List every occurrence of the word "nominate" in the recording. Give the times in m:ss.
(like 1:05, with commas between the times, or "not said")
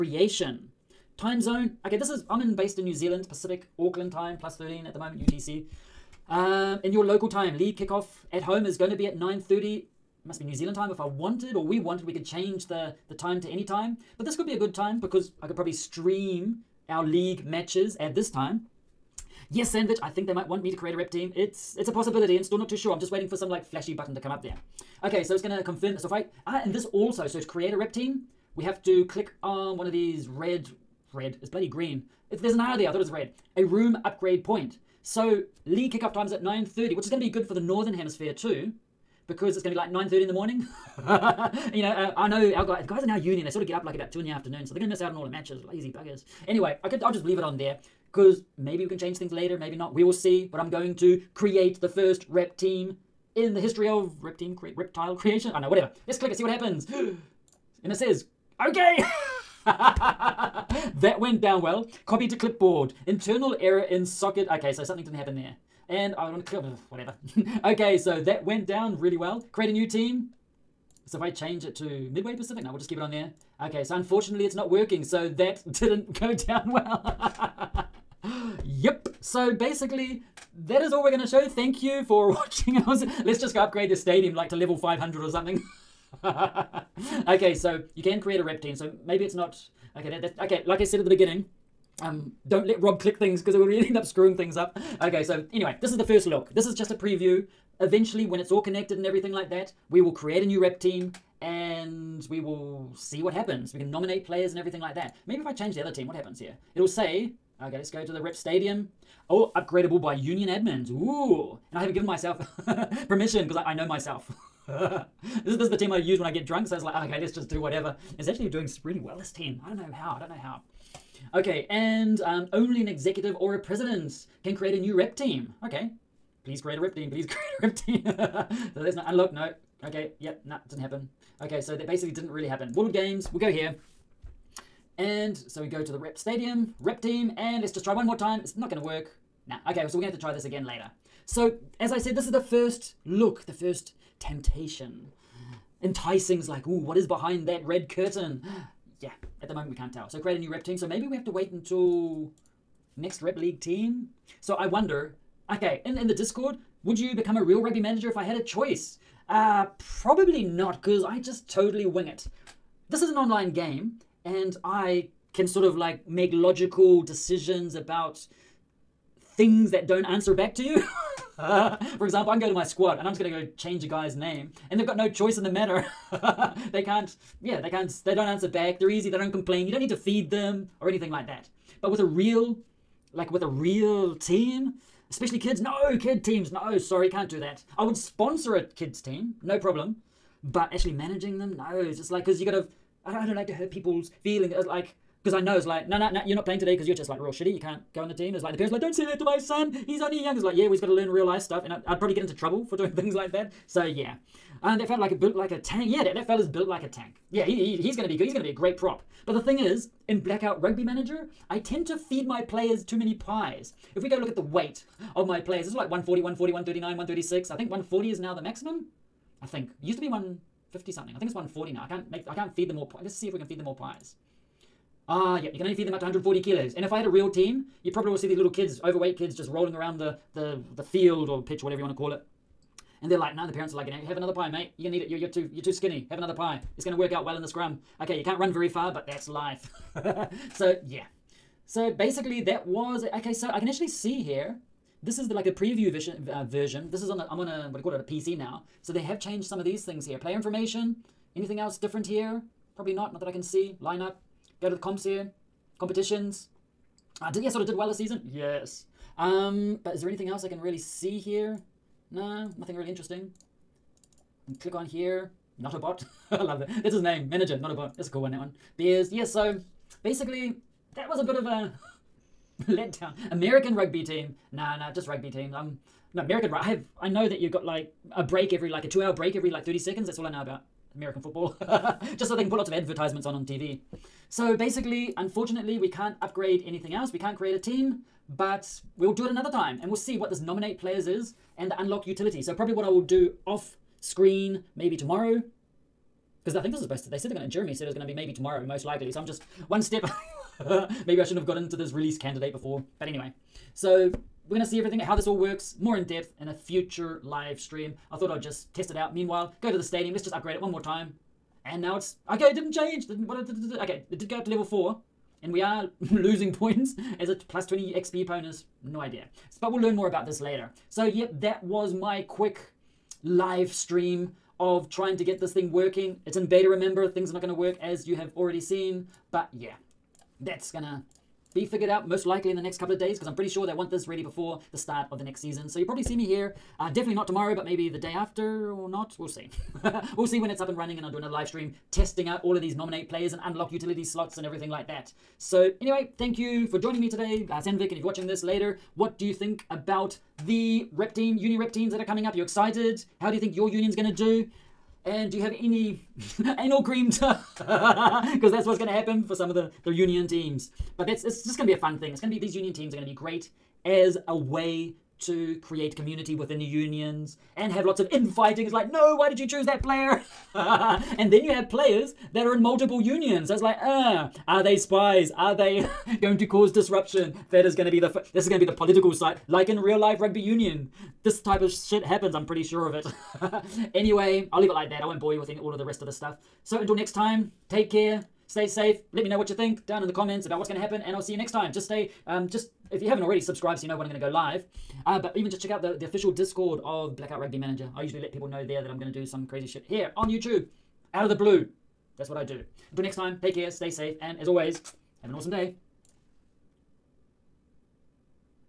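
1:43, 4:50, 5:42.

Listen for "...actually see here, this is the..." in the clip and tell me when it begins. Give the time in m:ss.
4:03.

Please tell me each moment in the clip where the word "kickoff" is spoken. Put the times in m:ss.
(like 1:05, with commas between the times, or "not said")
0:07, 0:35.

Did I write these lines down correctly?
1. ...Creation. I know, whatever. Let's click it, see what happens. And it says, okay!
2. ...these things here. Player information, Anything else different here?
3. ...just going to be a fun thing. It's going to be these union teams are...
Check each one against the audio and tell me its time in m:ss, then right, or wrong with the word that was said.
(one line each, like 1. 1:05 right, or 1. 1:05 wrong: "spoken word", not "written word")
1. 0:55 right
2. 4:09 right
3. 6:01 right.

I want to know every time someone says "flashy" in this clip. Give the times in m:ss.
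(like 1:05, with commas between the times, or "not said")
0:23.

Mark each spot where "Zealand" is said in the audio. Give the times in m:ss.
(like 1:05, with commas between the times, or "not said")
0:02, 0:10.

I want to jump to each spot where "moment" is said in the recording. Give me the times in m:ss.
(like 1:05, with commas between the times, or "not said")
0:04, 2:29.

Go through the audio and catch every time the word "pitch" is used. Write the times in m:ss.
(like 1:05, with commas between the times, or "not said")
3:51.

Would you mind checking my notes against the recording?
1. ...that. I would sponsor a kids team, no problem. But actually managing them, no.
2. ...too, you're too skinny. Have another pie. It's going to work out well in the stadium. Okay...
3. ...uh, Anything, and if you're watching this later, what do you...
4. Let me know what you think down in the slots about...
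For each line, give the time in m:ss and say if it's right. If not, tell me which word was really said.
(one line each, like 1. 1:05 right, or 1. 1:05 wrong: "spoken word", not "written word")
1. 3:07 right
2. 3:55 wrong: "scrum", not "stadium"
3. 5:47 wrong: "Sandvik", not "Anything"
4. 6:29 wrong: "comments", not "slots".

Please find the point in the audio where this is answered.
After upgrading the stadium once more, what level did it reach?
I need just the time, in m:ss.
5:14.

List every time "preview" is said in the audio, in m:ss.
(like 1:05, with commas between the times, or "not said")
1:36, 4:05.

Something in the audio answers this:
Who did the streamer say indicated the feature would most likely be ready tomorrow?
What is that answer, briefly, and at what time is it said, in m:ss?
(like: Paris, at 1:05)
Jeremy, at 4:57.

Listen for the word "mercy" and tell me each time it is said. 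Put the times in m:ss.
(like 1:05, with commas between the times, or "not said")
not said.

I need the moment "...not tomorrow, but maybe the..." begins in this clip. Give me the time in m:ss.
5:37.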